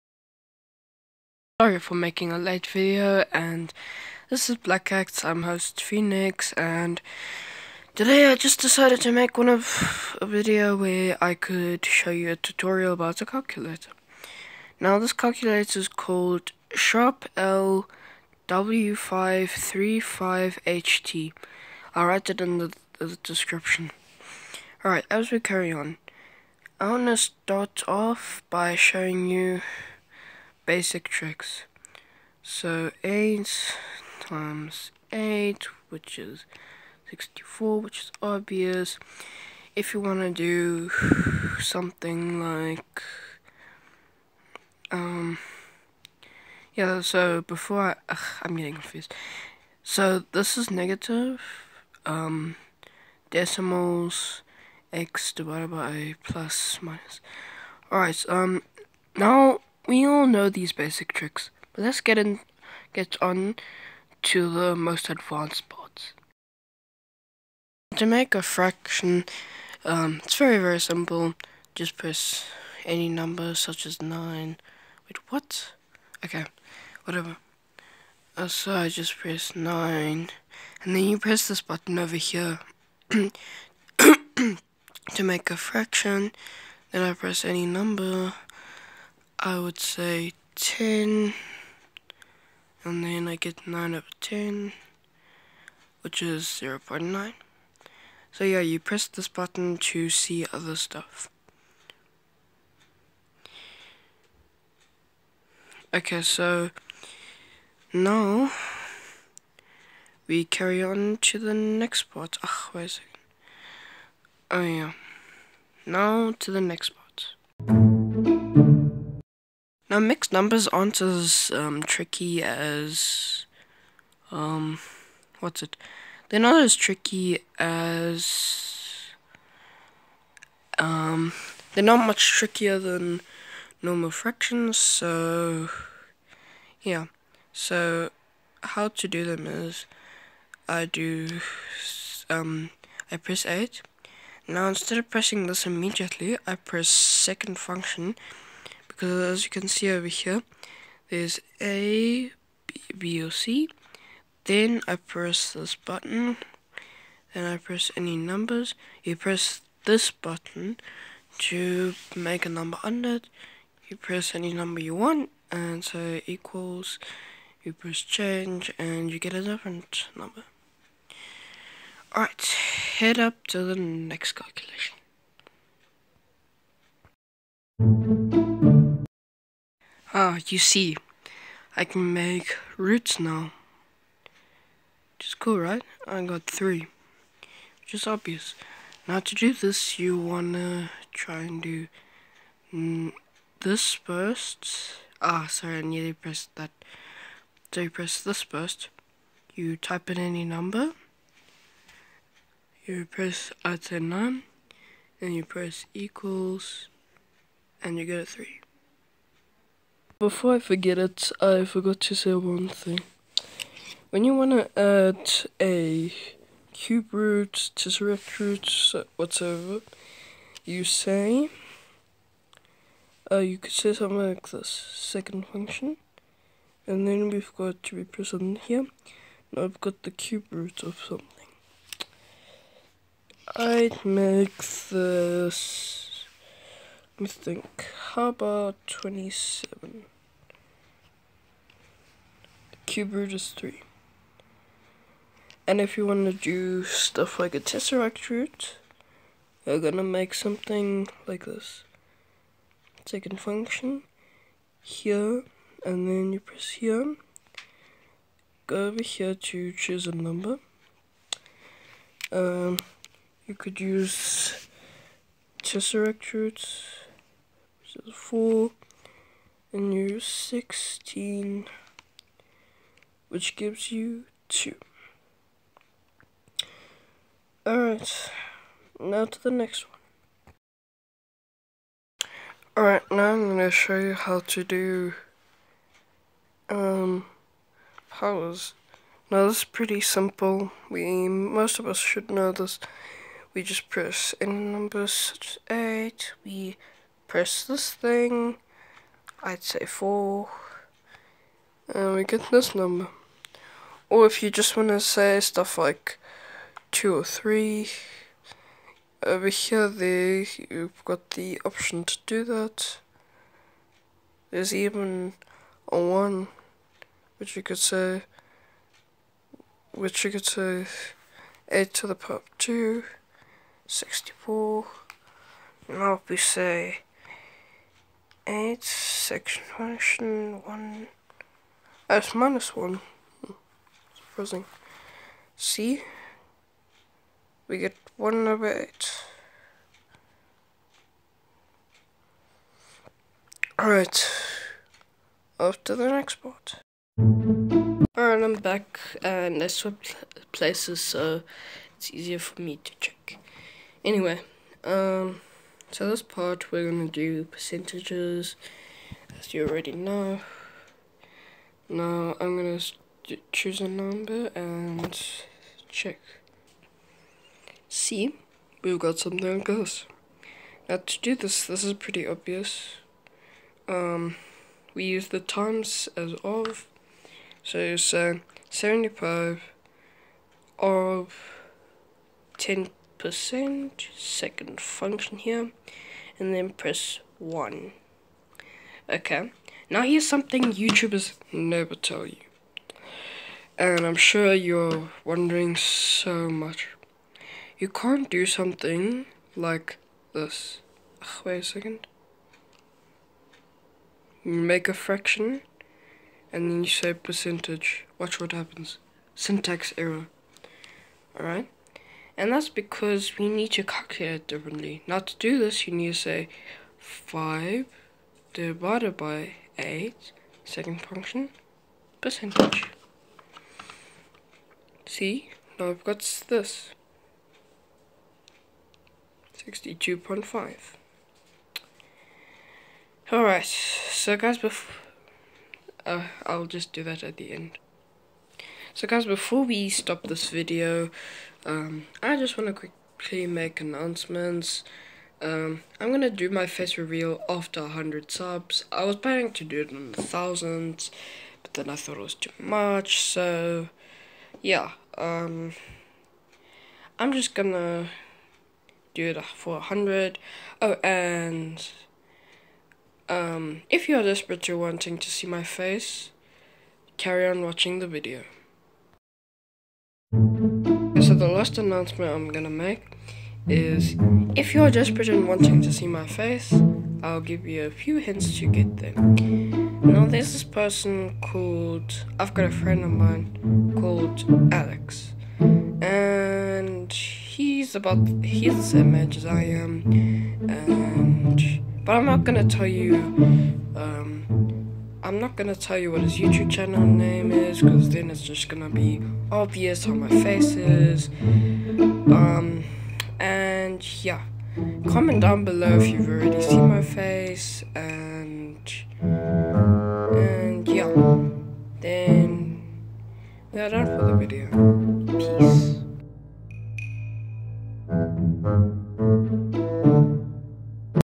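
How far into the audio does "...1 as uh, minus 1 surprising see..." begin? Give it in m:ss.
5:30.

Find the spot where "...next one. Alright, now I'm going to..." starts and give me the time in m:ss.
4:39.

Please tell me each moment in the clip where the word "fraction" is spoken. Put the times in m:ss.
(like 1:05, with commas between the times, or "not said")
1:08, 1:25, 2:14, 6:44.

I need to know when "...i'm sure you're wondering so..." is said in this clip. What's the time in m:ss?
6:34.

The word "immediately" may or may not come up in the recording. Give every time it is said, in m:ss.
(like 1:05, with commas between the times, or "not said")
2:25.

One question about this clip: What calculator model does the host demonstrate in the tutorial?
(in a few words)
Sharp L W535HT.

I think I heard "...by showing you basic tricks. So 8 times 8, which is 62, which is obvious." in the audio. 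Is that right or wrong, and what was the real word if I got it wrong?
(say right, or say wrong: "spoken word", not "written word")
wrong: "64", not "62".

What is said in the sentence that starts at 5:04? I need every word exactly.
Or if you just want to say stuff like 2 or 3, over here there you've got the option to do that.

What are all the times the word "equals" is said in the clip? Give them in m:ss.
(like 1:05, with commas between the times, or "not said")
2:46, 3:25.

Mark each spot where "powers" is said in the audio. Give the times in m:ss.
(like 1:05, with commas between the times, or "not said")
4:48, 5:22.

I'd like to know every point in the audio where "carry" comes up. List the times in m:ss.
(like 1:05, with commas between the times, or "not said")
0:25, 1:50, 7:47.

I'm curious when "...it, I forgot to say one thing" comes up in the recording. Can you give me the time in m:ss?
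3:30.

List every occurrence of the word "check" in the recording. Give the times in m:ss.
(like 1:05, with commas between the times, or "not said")
5:52, 6:05.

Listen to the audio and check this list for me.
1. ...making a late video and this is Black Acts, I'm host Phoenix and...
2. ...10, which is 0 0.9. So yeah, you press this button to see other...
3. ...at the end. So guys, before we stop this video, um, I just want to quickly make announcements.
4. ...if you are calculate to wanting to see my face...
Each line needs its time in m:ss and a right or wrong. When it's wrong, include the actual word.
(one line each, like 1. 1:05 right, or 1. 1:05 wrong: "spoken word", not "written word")
1. 0:01 right
2. 1:34 right
3. 7:17 right
4. 7:43 wrong: "desperate", not "calculate".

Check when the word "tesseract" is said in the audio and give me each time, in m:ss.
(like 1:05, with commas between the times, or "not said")
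3:37, 4:07, 4:25.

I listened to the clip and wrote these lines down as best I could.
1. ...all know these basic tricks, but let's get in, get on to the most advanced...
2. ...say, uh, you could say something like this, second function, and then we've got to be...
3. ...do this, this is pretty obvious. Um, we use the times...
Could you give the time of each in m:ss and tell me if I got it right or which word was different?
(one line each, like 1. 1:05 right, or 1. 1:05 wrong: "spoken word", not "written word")
1. 1:00 right
2. 3:40 right
3. 6:11 right.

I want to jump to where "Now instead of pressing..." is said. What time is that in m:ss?
2:24.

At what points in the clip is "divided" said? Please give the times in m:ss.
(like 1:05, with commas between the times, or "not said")
0:55, 6:58.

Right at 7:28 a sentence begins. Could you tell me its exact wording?
I was planning to do it on thousands, but then I thought it was too much, so yeah.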